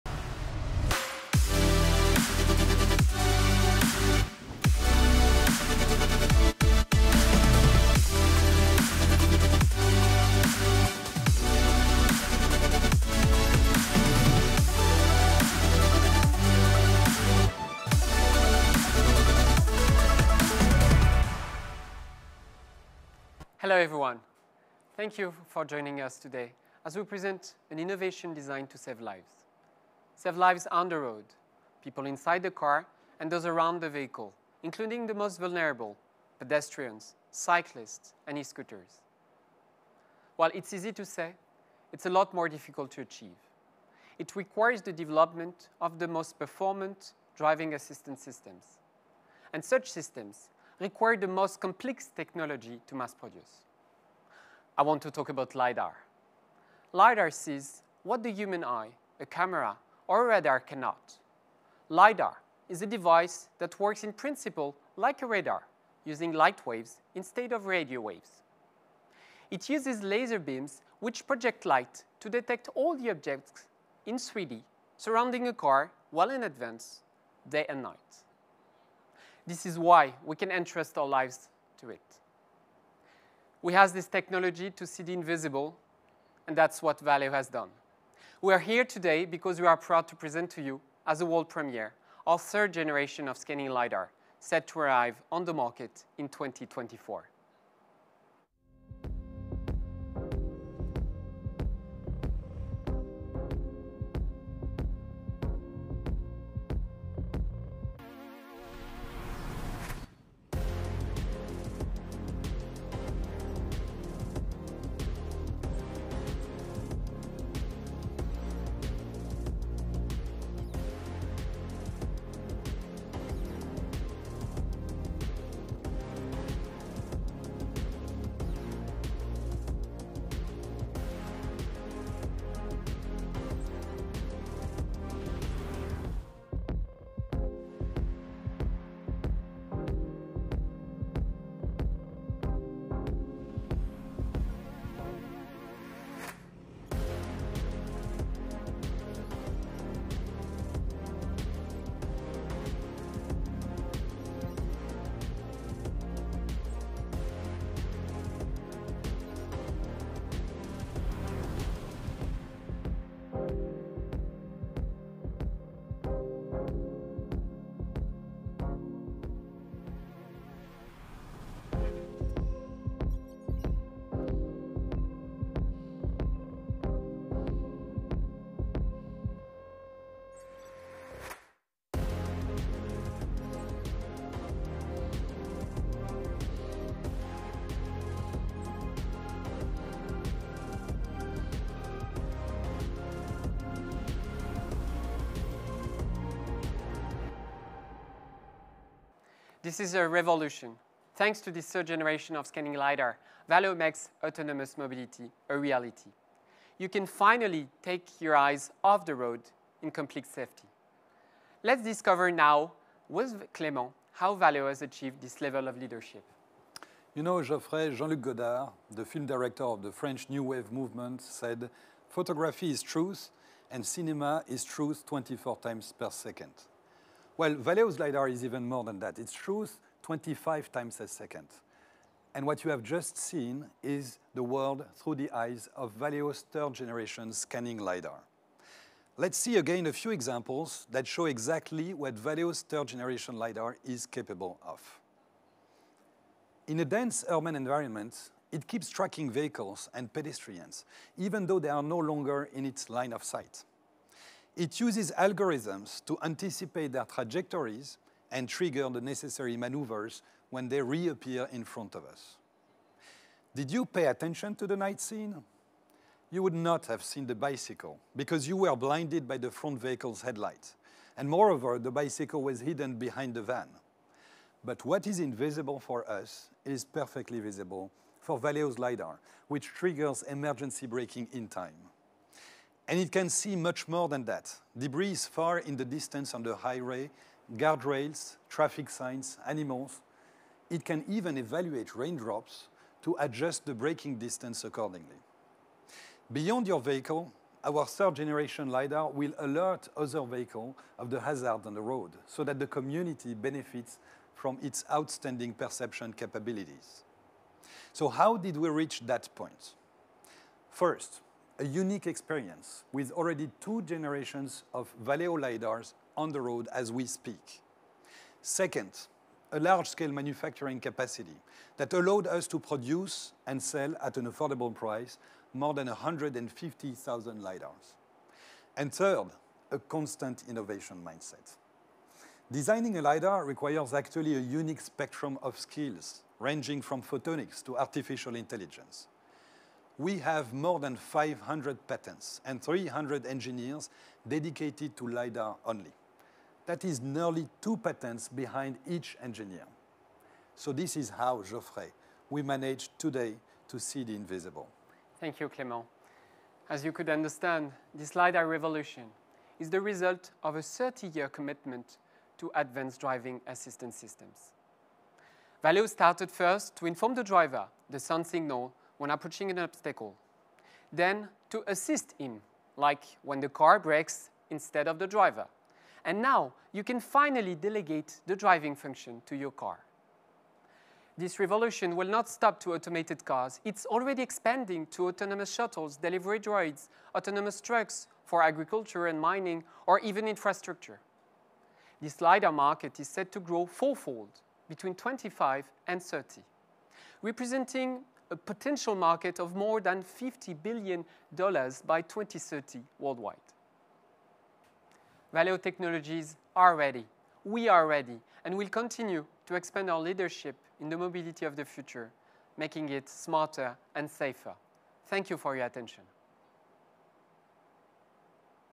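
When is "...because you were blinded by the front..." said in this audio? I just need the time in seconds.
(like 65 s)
268 s.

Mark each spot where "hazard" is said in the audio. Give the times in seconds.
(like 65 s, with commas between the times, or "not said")
301 s.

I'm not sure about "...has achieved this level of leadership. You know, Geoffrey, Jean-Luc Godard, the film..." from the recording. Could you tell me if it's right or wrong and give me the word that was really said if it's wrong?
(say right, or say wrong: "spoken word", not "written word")
right.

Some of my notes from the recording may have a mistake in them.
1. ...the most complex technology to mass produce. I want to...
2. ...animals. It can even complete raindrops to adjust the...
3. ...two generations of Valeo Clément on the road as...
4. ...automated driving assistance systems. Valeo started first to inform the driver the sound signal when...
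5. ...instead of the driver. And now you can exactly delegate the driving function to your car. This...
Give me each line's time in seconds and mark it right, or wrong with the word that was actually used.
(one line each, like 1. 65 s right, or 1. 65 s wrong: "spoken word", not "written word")
1. 51 s right
2. 289 s wrong: "evaluate", not "complete"
3. 313 s wrong: "LiDARs", not "Clément"
4. 362 s wrong: "advanced", not "automated"
5. 374 s wrong: "finally", not "exactly".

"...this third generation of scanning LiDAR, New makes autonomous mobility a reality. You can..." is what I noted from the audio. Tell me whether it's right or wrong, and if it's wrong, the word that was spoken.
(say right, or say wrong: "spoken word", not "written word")
wrong: "Valeo", not "New".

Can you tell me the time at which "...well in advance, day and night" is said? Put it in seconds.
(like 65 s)
76 s.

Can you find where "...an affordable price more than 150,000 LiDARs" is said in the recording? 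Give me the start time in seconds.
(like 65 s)
324 s.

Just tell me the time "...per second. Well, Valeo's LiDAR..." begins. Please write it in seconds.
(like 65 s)
225 s.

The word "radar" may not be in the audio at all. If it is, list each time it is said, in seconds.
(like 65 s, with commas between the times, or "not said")
60 s, 65 s.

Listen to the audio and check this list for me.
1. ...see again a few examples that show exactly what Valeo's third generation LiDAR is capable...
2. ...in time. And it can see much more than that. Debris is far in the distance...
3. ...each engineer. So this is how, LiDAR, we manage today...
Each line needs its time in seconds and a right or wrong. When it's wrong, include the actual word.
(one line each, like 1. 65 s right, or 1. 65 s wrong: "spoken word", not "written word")
1. 239 s right
2. 281 s right
3. 348 s wrong: "Geoffrey", not "LiDAR".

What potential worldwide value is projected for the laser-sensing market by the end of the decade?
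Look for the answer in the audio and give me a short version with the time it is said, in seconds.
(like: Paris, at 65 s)
more than $50 billion, at 399 s.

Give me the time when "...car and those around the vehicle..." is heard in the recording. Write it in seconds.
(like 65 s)
32 s.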